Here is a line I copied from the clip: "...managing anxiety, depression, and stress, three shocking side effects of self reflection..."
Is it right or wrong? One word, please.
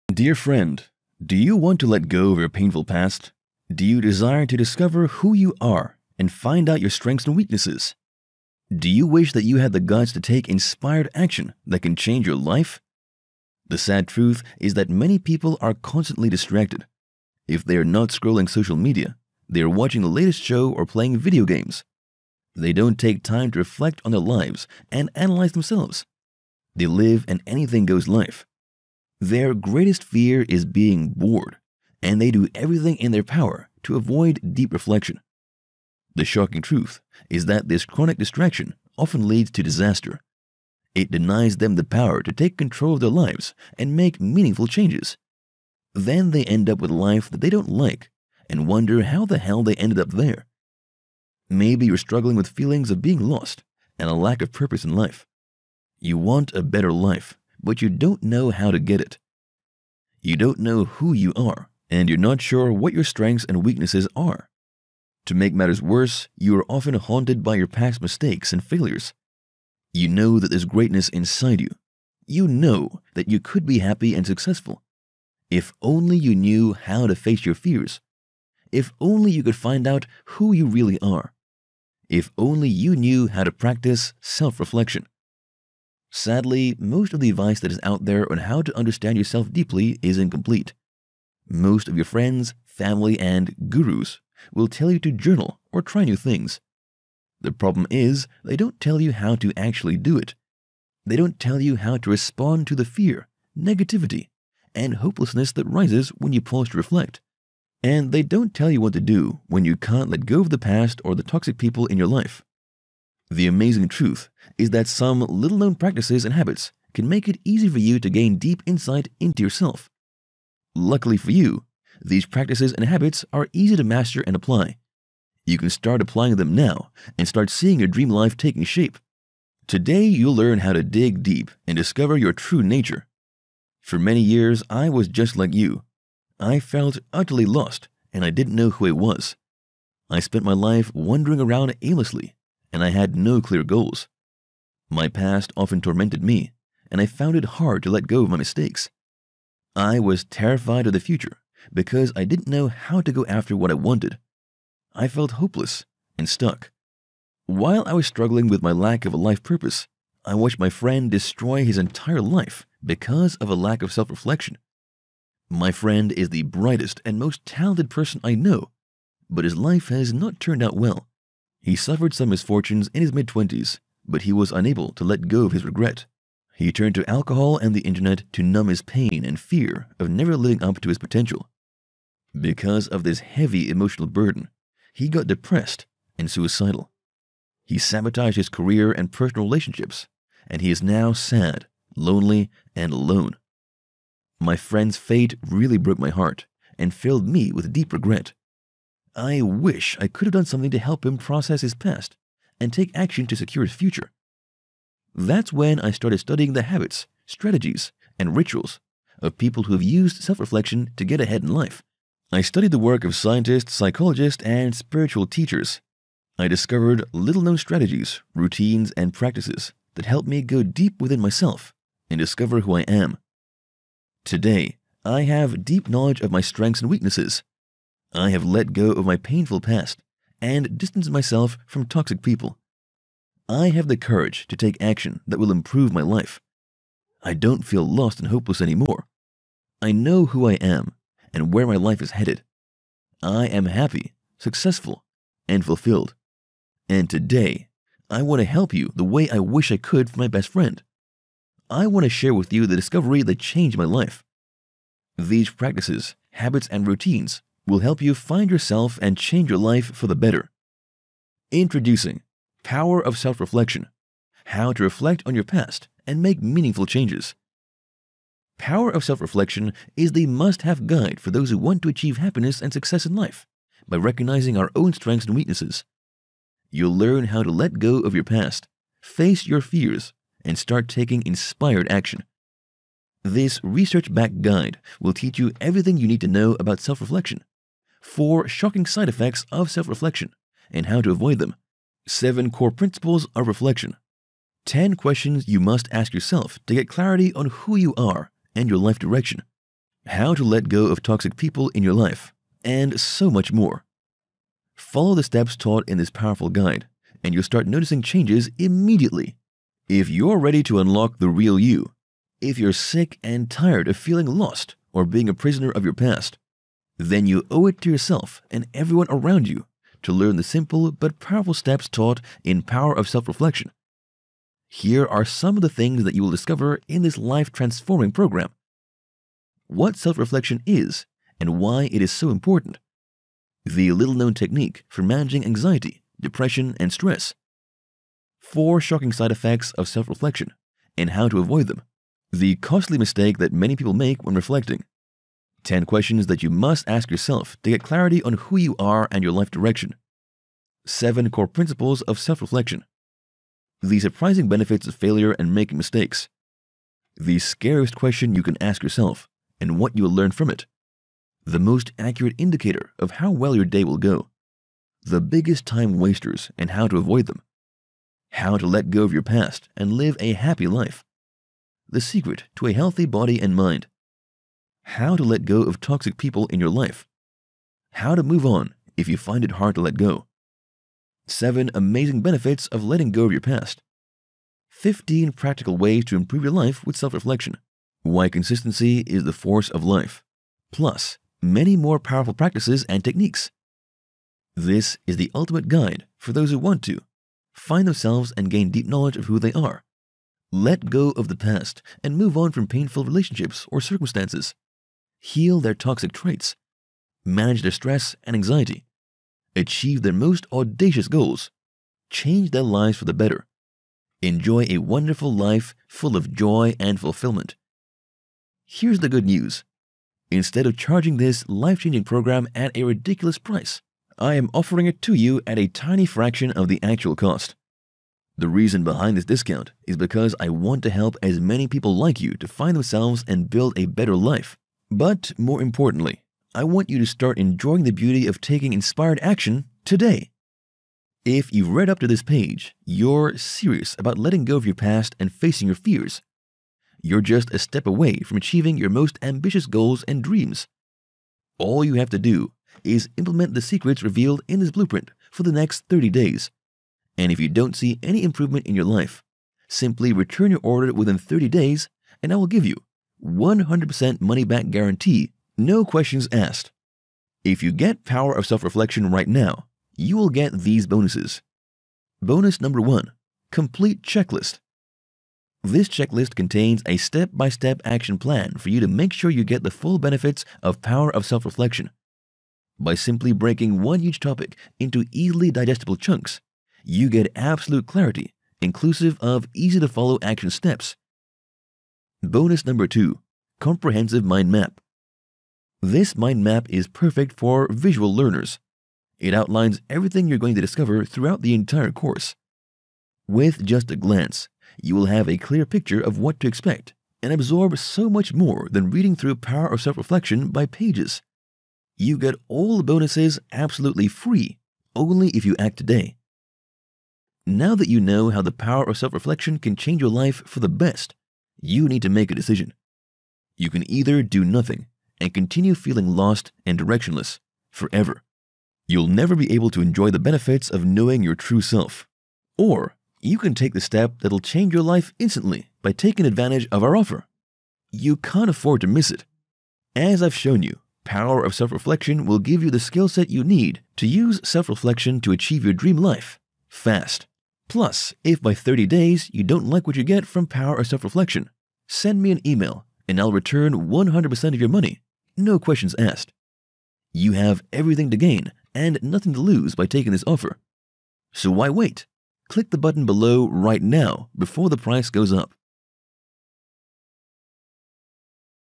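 wrong.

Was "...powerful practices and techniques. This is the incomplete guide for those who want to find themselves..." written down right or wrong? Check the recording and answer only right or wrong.
wrong.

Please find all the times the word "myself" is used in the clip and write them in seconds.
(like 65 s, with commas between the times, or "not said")
221 s, 231 s.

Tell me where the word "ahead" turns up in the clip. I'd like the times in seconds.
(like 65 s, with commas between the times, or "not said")
211 s.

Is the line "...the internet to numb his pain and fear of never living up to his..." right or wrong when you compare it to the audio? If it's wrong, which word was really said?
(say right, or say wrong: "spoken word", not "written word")
right.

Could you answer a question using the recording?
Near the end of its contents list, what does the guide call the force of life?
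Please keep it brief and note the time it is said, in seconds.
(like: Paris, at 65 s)
Consistency, at 388 s.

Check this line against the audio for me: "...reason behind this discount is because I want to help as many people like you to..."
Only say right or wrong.
right.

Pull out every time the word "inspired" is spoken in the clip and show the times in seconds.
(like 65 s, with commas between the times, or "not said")
10 s, 281 s, 438 s.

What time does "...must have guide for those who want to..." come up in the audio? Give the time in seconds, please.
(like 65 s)
270 s.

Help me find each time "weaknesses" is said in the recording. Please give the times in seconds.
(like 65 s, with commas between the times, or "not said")
7 s, 63 s, 226 s, 275 s.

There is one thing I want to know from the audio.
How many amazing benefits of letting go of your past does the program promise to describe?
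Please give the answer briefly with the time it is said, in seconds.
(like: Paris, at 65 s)
7, at 381 s.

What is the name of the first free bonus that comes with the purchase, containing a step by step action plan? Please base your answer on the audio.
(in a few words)
Complete Checklist.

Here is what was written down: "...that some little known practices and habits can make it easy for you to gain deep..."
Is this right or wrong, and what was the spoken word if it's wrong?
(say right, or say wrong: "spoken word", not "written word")
right.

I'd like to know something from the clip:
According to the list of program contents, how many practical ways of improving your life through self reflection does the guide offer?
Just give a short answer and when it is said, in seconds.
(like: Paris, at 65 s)
15, at 384 s.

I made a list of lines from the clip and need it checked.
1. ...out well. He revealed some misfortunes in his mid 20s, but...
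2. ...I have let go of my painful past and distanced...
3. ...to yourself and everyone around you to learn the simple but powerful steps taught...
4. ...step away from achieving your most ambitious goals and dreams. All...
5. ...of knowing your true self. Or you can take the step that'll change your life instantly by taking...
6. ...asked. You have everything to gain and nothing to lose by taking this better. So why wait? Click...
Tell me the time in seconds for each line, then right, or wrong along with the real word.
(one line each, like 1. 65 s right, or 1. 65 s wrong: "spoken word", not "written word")
1. 170 s wrong: "suffered", not "revealed"
2. 228 s right
3. 317 s right
4. 447 s right
5. 530 s right
6. 555 s wrong: "offer", not "better".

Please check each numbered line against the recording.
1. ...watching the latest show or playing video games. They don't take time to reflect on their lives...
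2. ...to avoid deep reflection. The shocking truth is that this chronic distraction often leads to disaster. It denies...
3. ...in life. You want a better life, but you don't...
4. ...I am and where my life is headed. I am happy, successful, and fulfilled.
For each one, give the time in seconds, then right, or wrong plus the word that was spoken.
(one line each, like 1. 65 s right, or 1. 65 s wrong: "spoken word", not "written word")
1. 19 s right
2. 33 s right
3. 54 s right
4. 240 s right.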